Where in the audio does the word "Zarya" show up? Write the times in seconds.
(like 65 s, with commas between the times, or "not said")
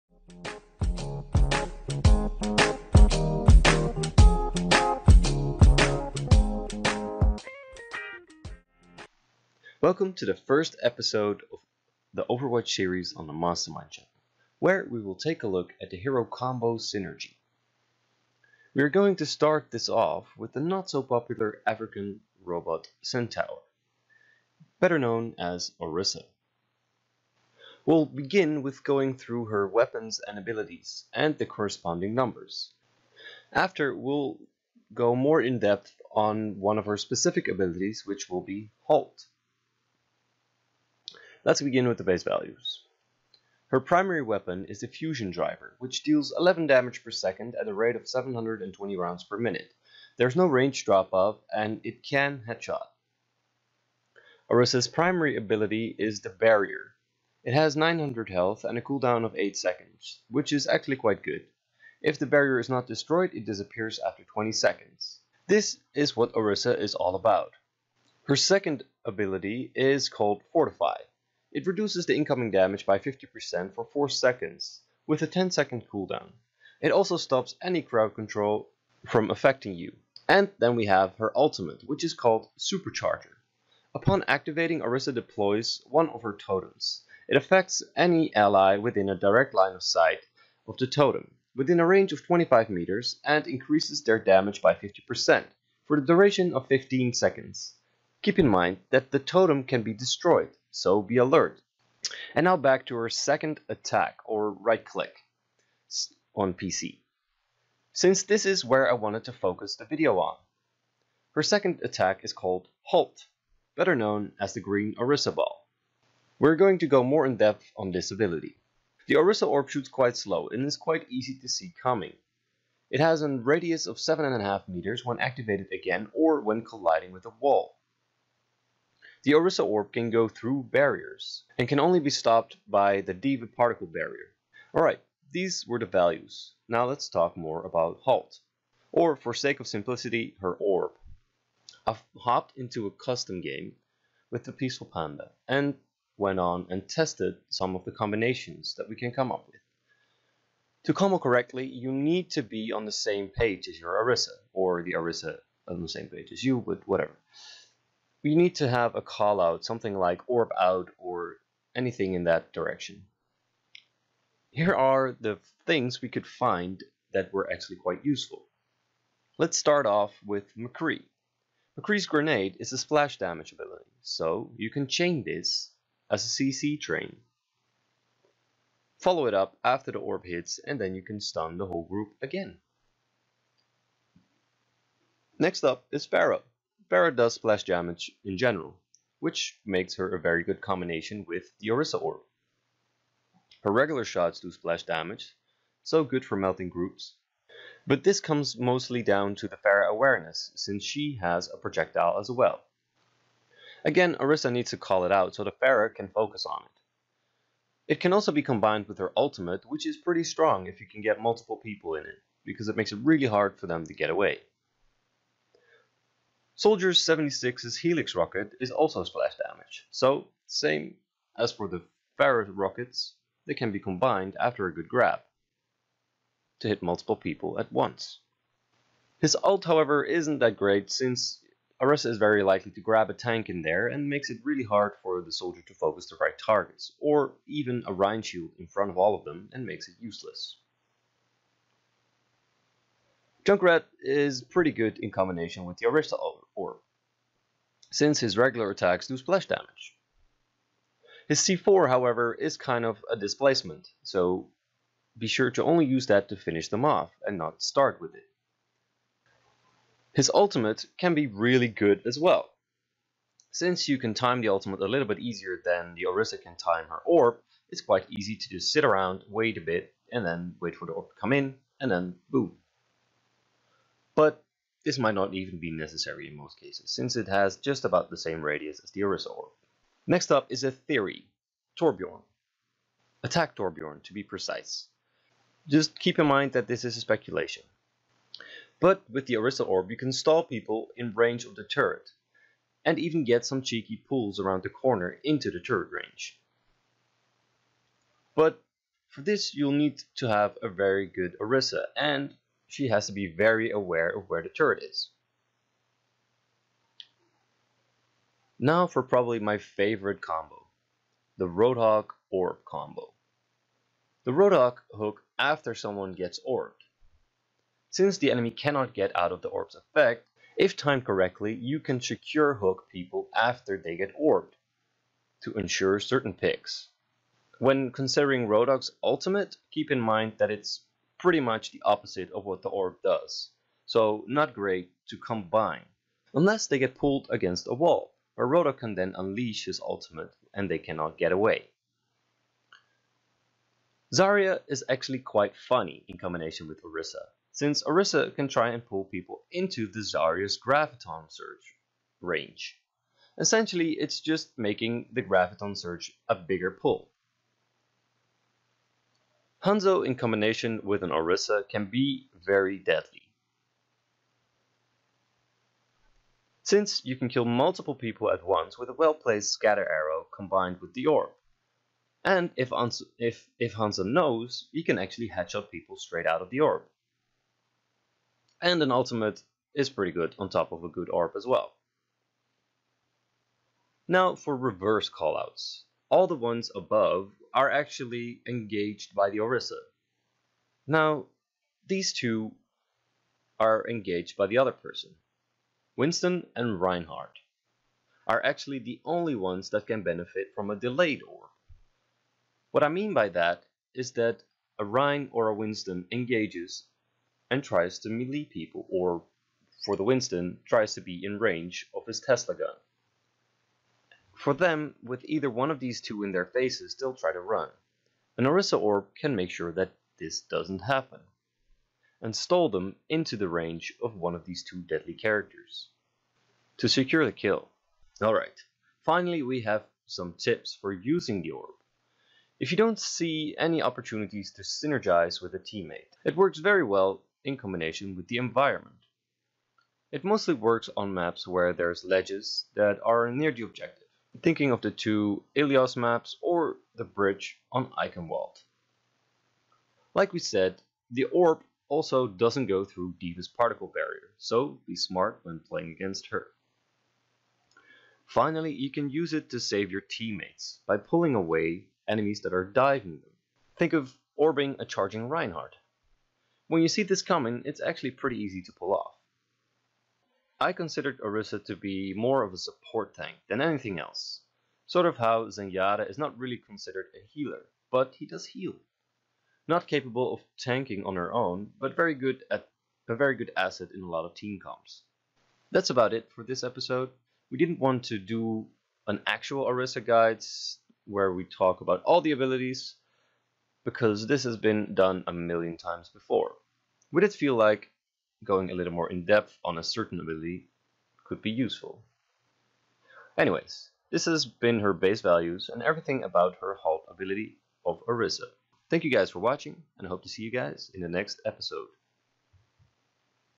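344 s, 349 s.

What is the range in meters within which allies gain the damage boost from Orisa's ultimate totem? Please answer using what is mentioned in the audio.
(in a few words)
25 meters.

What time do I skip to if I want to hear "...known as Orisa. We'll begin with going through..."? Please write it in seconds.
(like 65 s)
24 s.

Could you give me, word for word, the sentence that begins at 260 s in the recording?
His ultimate can be really good as well.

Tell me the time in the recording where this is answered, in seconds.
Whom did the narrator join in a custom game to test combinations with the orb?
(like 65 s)
144 s.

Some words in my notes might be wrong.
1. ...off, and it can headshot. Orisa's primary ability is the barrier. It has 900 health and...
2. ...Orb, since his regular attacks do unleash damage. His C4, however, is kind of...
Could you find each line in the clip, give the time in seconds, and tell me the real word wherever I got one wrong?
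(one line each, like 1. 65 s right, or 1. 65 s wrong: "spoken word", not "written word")
1. 51 s right
2. 246 s wrong: "splash", not "unleash".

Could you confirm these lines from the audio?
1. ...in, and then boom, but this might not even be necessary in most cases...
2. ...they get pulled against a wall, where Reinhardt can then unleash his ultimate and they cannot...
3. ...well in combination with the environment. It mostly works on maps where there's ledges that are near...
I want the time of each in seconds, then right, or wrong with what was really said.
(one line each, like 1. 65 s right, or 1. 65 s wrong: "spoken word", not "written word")
1. 271 s right
2. 336 s wrong: "Roadhog", not "Reinhardt"
3. 436 s right.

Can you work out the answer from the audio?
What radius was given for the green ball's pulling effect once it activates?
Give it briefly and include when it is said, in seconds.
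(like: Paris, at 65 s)
7.5 meters, at 123 s.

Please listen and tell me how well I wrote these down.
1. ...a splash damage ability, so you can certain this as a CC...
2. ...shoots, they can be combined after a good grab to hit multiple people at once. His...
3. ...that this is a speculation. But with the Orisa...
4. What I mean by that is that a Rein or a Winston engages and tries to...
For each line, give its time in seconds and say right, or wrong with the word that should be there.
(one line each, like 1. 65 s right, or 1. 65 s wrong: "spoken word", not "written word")
1. 172 s wrong: "chain", not "certain"
2. 222 s wrong: "rockets", not "shoots"
3. 286 s right
4. 402 s right.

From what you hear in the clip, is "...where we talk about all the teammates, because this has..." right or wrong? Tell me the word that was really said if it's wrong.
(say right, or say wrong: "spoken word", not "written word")
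wrong: "abilities", not "teammates".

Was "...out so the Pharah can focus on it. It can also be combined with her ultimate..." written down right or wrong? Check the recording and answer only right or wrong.
right.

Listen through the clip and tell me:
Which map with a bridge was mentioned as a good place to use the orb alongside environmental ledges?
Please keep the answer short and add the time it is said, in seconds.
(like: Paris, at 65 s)
Eichenwald, at 447 s.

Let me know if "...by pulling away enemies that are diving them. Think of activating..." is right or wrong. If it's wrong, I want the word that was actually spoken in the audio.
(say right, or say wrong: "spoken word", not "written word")
wrong: "orbing", not "activating".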